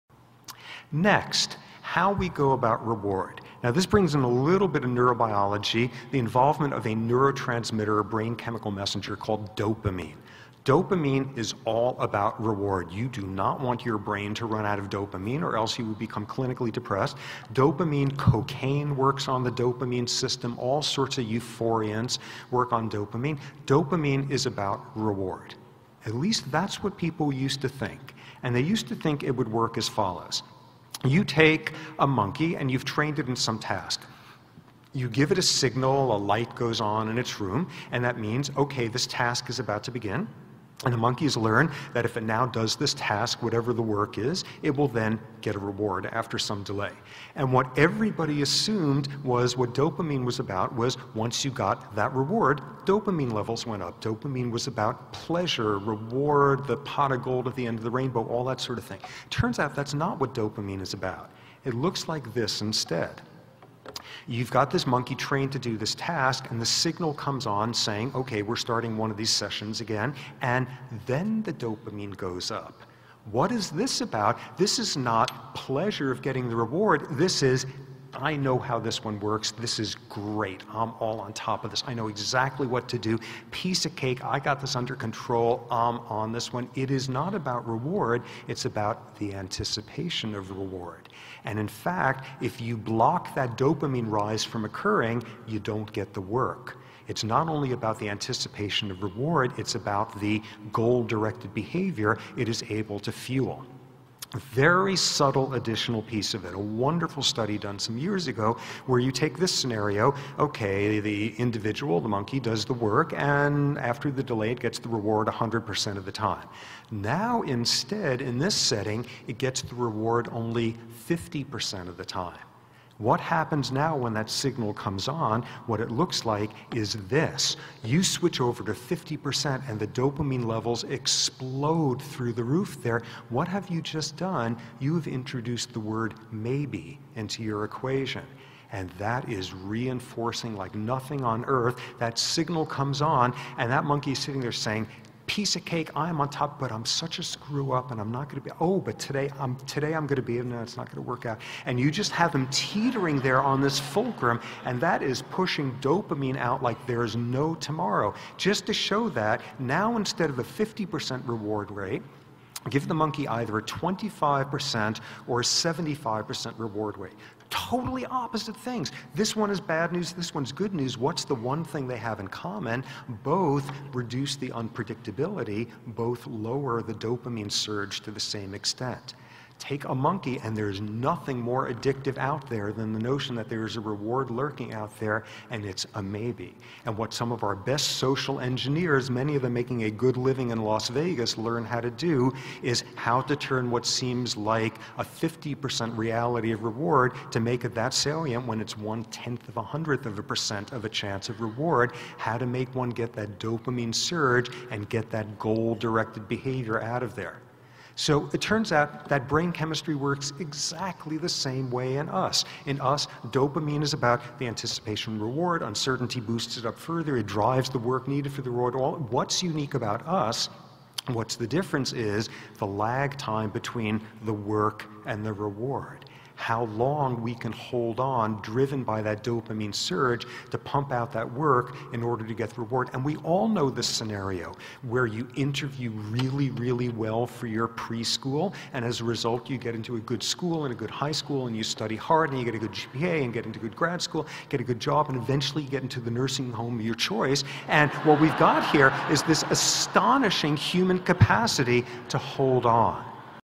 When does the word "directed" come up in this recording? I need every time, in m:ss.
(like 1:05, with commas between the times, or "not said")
1:41, 3:25.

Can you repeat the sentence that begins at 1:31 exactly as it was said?
And in fact, if you block that dopamine rise from occurring, you don't get the work.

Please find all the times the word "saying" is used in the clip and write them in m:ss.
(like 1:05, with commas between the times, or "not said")
1:07, 2:24.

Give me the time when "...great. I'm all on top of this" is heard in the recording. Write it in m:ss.
1:20.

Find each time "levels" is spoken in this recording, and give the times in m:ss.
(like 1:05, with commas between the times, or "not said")
0:53, 2:10.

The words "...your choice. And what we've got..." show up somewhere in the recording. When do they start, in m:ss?
4:06.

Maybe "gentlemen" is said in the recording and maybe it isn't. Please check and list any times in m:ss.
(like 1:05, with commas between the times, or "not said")
not said.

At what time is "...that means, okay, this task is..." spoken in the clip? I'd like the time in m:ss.
0:38.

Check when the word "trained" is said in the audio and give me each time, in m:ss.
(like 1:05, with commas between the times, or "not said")
0:32, 1:05.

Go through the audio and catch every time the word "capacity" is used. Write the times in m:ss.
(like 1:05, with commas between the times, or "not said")
4:10.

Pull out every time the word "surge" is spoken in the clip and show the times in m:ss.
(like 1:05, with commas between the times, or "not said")
2:57, 3:23, 3:49.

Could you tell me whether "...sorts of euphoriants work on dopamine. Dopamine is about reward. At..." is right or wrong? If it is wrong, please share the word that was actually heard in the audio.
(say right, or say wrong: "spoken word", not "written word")
right.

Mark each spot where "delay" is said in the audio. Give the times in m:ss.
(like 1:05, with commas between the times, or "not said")
0:46, 1:54.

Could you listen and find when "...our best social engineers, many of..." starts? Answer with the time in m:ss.
3:07.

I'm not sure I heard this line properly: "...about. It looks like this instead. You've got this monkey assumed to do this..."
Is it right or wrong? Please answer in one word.
wrong.